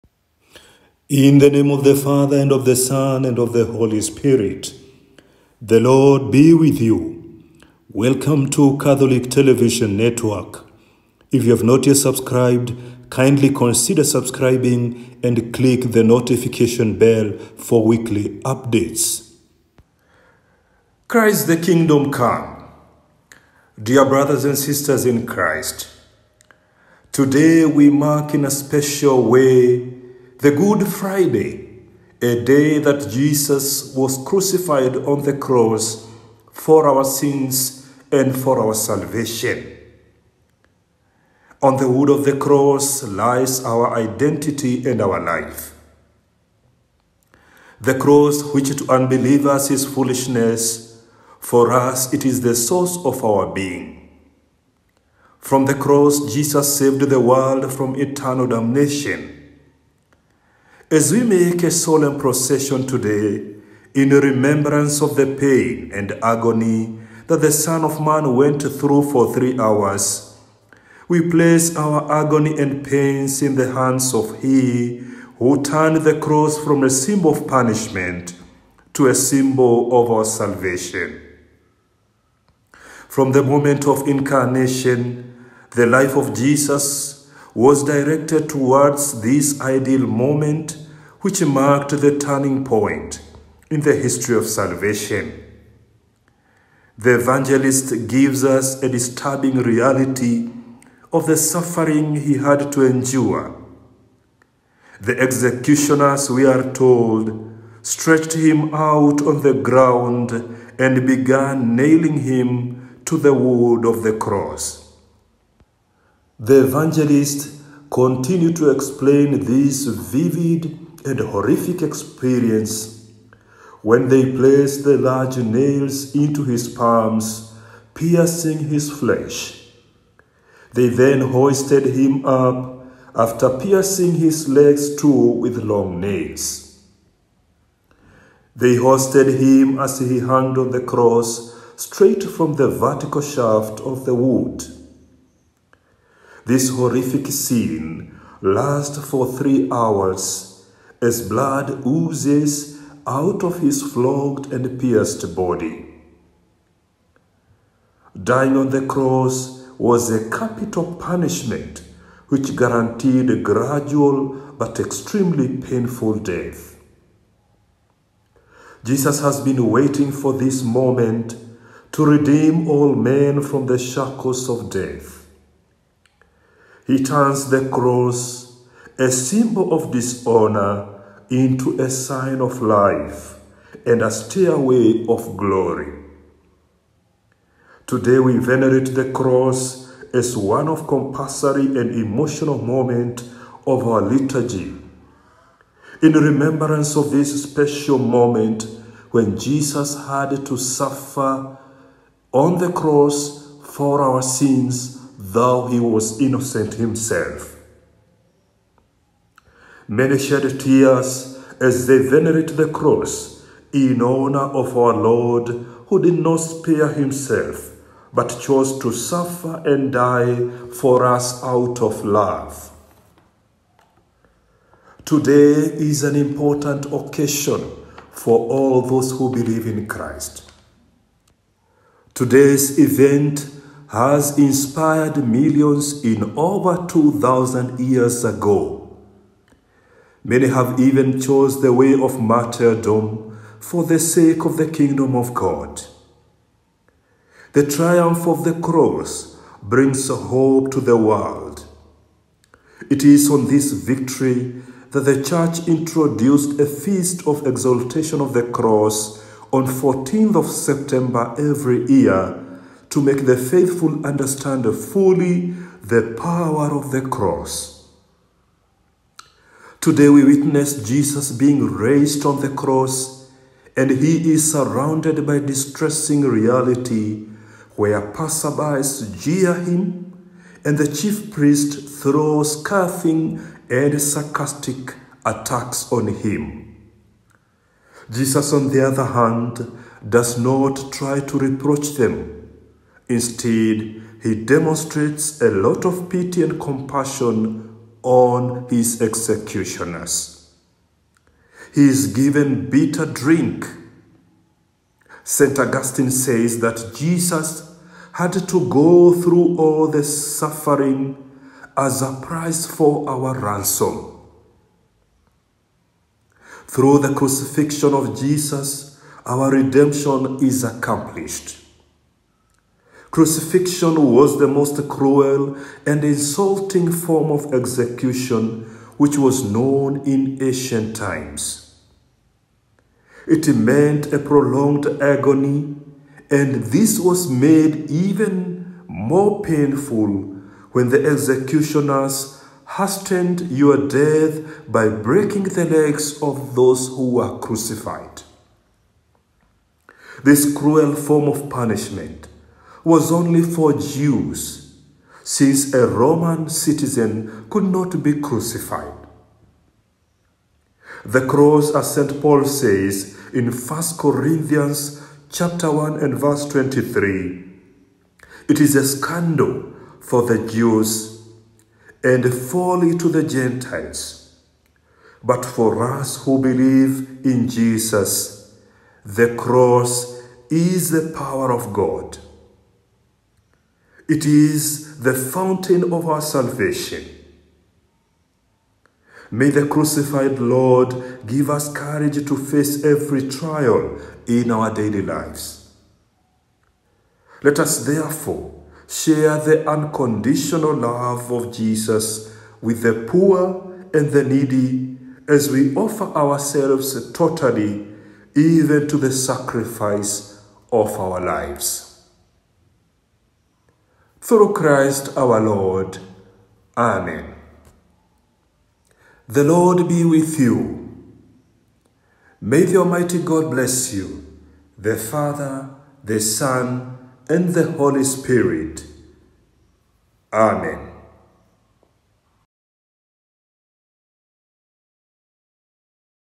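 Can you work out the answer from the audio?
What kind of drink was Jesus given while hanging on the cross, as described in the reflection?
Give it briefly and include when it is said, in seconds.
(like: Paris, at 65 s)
Bitter drink, at 302 s.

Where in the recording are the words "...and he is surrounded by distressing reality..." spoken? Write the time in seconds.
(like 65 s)
273 s.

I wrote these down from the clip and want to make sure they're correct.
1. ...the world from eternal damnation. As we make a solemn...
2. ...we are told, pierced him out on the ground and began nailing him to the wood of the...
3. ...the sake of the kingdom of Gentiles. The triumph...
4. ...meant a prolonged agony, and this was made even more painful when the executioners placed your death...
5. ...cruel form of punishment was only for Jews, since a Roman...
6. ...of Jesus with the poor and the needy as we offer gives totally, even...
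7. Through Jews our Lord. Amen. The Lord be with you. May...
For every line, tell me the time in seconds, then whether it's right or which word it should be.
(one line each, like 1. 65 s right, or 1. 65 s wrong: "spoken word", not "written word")
1. 57 s right
2. 106 s wrong: "stretched", not "pierced"
3. 243 s wrong: "God", not "Gentiles"
4. 333 s wrong: "hastened", not "placed"
5. 350 s right
6. 401 s wrong: "ourselves", not "gives"
7. 414 s wrong: "Christ", not "Jews".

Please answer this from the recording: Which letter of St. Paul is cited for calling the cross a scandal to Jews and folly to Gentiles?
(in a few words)
1 Corinthians.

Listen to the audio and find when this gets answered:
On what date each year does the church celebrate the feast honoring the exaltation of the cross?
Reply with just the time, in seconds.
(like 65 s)
259 s.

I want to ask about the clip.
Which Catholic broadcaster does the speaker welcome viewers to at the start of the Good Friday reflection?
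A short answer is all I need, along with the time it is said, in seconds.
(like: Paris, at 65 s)
Catholic Television Network, at 8 s.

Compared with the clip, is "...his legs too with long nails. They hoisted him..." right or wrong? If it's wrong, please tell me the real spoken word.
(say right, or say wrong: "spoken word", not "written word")
right.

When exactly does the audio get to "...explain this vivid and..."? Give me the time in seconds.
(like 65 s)
118 s.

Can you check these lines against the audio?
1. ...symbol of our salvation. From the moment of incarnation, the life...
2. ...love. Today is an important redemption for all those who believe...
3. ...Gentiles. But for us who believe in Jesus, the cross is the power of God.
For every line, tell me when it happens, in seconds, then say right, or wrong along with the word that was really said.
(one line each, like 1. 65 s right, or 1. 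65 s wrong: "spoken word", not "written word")
1. 79 s right
2. 222 s wrong: "occasion", not "redemption"
3. 373 s right.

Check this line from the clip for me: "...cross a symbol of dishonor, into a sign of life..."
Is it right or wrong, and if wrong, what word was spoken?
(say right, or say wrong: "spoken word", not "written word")
right.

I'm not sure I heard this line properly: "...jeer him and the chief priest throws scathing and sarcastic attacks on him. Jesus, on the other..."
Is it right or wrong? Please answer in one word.
right.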